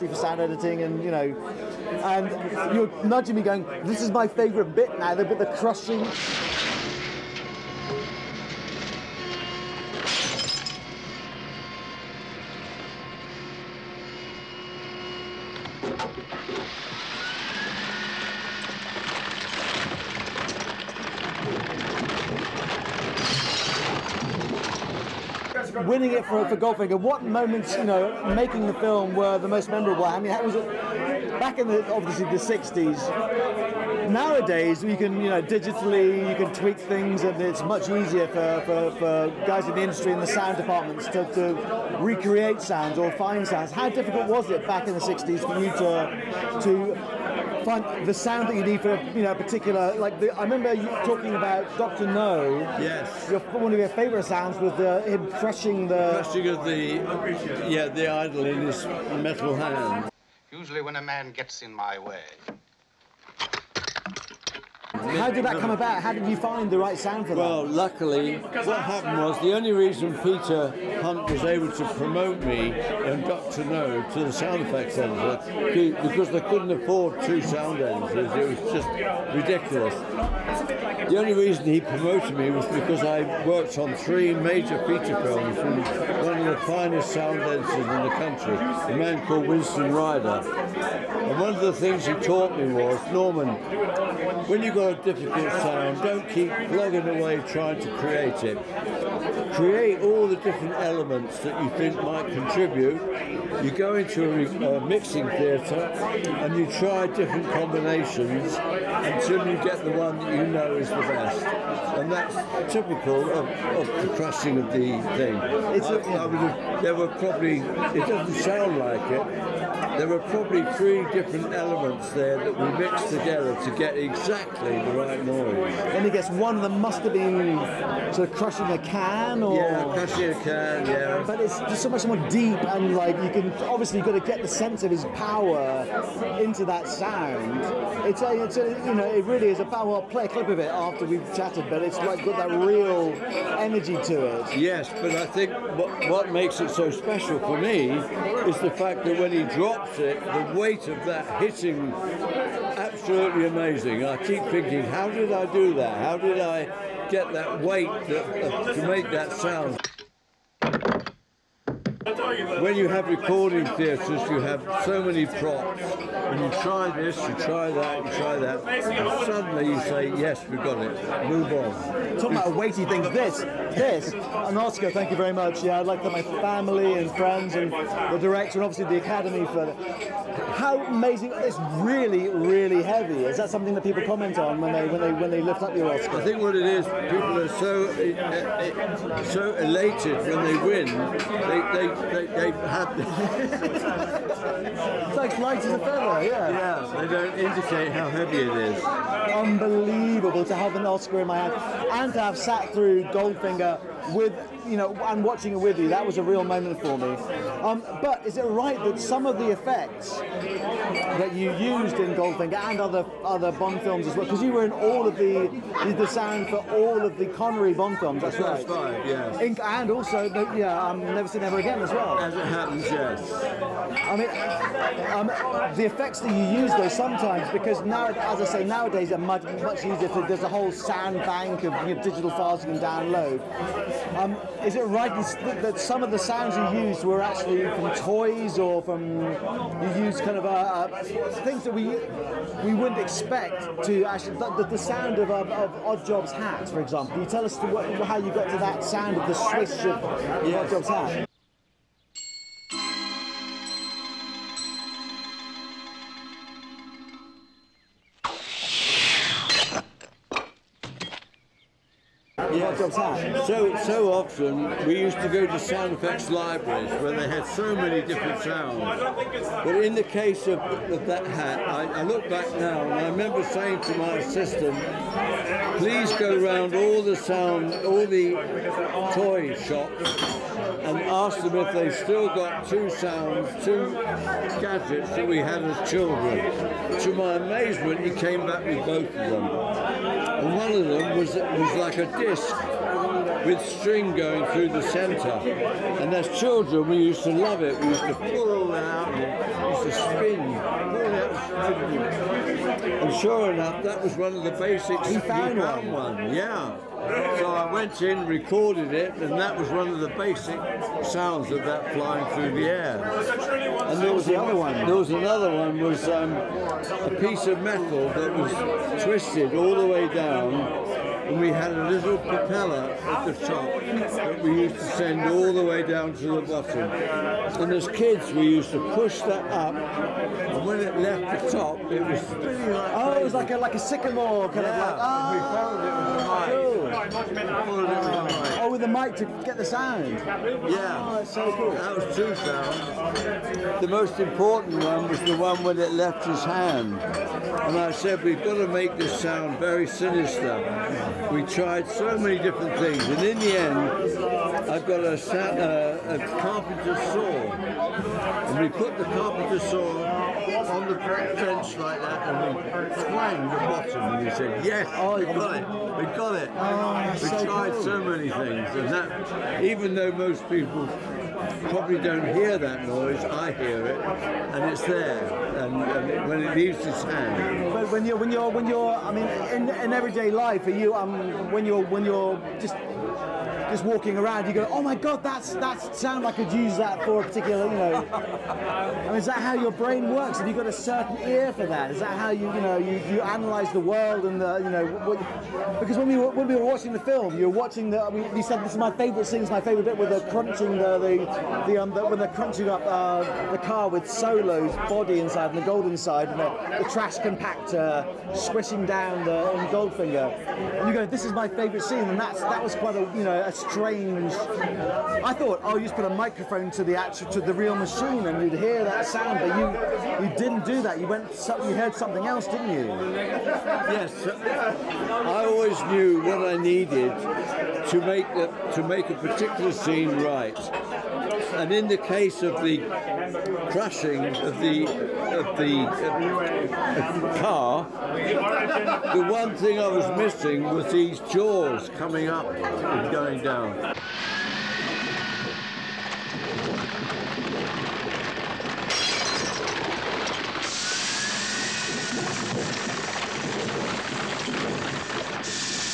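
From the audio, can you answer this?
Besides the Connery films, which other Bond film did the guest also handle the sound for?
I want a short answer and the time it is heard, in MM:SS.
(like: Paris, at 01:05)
Never Say Never Again, at 03:41.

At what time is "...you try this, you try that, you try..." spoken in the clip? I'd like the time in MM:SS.
02:46.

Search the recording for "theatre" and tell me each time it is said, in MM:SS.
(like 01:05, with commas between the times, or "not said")
01:45, 02:43.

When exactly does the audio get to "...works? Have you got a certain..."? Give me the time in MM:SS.
06:30.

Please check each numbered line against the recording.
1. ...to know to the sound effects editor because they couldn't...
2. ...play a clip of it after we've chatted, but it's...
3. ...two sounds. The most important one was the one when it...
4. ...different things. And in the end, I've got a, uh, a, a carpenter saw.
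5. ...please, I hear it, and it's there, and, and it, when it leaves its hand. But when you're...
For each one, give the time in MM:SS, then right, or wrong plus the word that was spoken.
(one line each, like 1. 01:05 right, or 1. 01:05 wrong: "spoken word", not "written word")
1. 01:13 right
2. 02:20 right
3. 05:42 right
4. 05:52 right
5. 06:12 wrong: "noise", not "please".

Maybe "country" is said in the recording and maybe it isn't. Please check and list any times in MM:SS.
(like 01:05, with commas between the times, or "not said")
01:28.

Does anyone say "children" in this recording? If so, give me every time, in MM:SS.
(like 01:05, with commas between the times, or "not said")
04:45, 04:56.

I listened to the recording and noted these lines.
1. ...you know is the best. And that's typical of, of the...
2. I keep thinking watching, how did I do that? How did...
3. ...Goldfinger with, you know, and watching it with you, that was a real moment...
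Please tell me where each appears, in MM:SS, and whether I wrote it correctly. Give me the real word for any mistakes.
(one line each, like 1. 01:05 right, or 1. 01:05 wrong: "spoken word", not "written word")
1. 01:50 right
2. 02:34 wrong: "thinking", not "watching"
3. 03:23 right.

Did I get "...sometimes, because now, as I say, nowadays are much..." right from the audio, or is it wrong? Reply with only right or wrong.
right.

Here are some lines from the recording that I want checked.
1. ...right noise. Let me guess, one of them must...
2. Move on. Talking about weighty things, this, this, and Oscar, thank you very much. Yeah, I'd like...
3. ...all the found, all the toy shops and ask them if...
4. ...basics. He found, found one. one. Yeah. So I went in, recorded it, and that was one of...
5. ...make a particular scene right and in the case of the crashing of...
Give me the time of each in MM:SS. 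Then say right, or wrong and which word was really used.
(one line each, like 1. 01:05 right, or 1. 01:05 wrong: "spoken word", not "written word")
1. 02:04 right
2. 02:51 right
3. 04:36 wrong: "sound", not "found"
4. 05:04 right
5. 07:08 right.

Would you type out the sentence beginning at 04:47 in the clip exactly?
To my amazement, he came back with both of them.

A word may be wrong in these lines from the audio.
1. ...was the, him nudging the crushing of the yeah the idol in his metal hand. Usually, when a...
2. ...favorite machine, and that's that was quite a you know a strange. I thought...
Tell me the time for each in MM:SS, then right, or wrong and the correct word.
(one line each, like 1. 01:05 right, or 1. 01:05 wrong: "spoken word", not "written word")
1. 00:54 wrong: "crushing", not "nudging"
2. 06:51 wrong: "scene", not "machine".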